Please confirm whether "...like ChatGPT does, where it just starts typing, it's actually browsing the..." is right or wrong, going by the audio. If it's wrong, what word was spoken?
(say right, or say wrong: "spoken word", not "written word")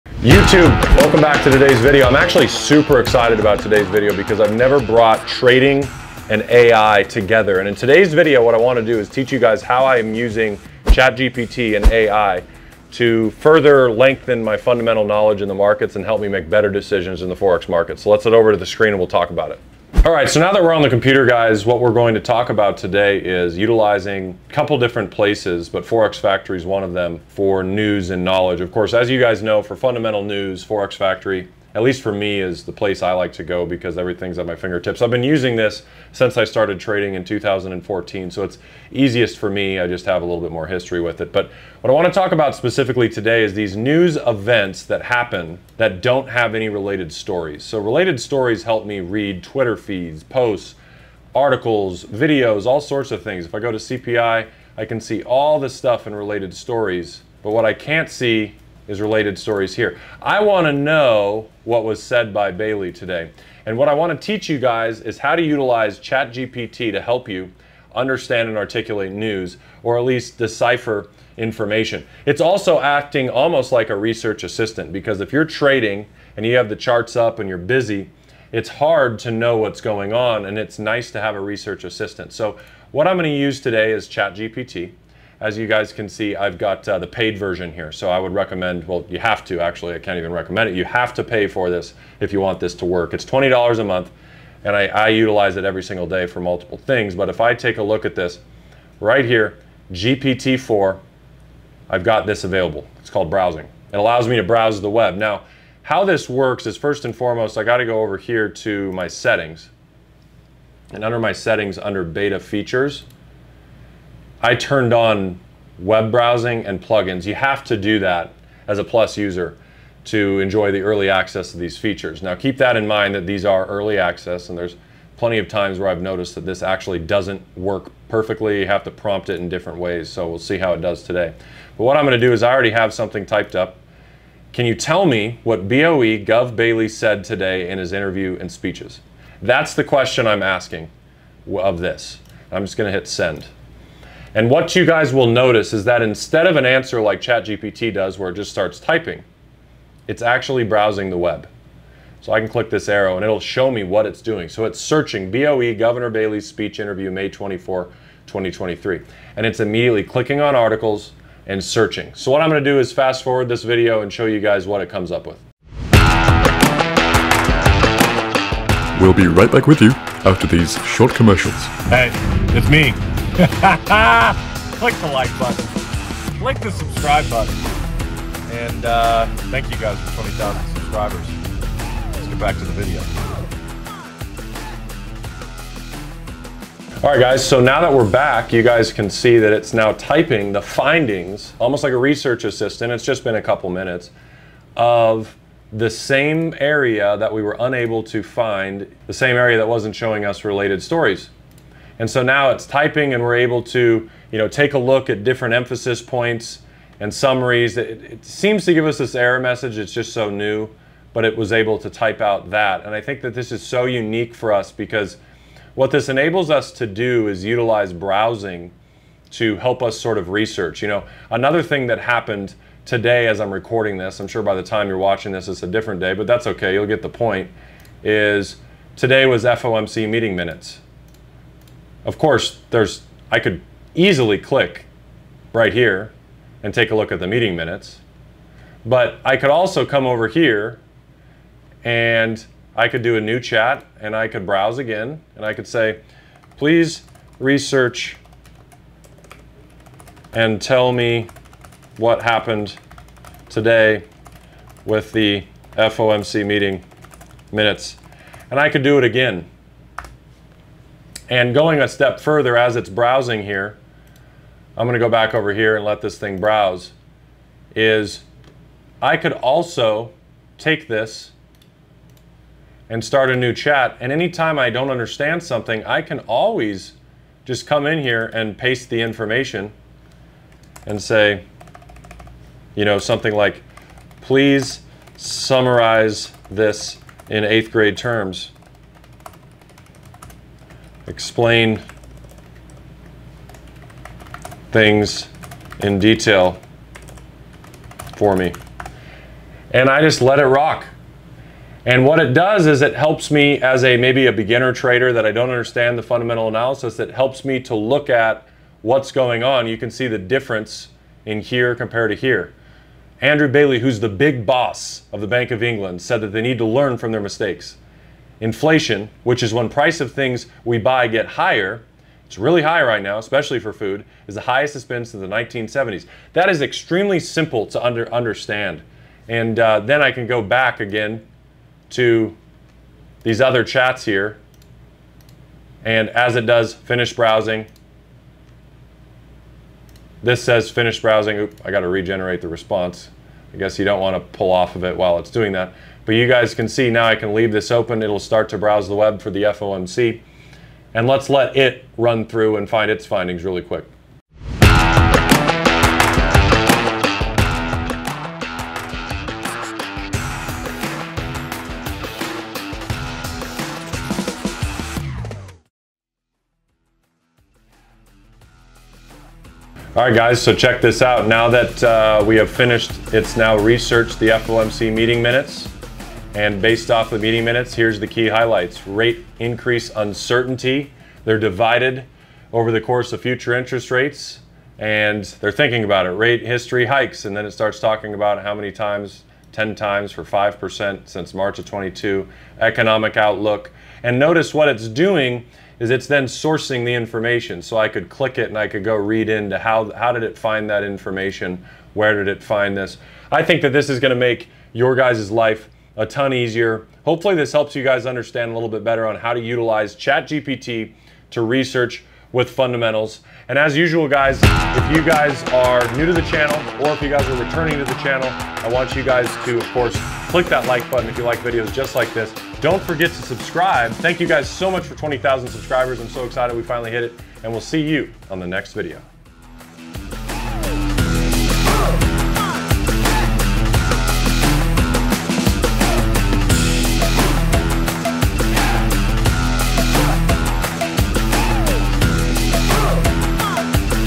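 right.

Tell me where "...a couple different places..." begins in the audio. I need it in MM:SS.
00:24.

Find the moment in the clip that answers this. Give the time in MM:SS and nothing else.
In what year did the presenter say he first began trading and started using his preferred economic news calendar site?
00:37.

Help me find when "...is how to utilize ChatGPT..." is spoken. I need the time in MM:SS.
01:05.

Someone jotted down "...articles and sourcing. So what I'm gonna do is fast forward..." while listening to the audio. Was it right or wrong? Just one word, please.
wrong.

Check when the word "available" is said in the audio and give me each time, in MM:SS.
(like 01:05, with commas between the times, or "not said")
01:42.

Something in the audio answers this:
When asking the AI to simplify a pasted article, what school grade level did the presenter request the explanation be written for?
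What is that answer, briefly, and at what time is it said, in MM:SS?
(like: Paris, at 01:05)
eighth grade, at 04:47.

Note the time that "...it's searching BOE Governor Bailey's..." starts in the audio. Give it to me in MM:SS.
02:34.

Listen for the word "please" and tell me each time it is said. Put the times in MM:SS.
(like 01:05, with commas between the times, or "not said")
04:06, 04:44.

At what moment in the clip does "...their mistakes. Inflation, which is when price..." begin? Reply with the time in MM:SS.
05:17.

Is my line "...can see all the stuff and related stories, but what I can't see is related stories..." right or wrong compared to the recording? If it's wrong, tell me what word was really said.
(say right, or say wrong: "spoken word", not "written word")
right.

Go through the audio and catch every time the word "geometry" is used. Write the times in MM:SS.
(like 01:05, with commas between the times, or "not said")
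not said.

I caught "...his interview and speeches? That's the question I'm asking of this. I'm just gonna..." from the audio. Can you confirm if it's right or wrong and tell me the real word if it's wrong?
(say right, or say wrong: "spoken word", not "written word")
right.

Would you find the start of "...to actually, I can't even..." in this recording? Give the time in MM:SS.
01:29.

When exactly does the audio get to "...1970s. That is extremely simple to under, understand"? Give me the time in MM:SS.
05:25.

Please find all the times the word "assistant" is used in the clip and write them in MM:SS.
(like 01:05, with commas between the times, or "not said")
01:14, 01:21, 03:12.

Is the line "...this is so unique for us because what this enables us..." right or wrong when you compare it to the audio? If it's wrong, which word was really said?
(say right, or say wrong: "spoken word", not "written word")
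right.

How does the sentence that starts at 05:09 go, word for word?
You can see the difference in here compared to here.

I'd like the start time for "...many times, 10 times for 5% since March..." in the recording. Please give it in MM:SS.
06:28.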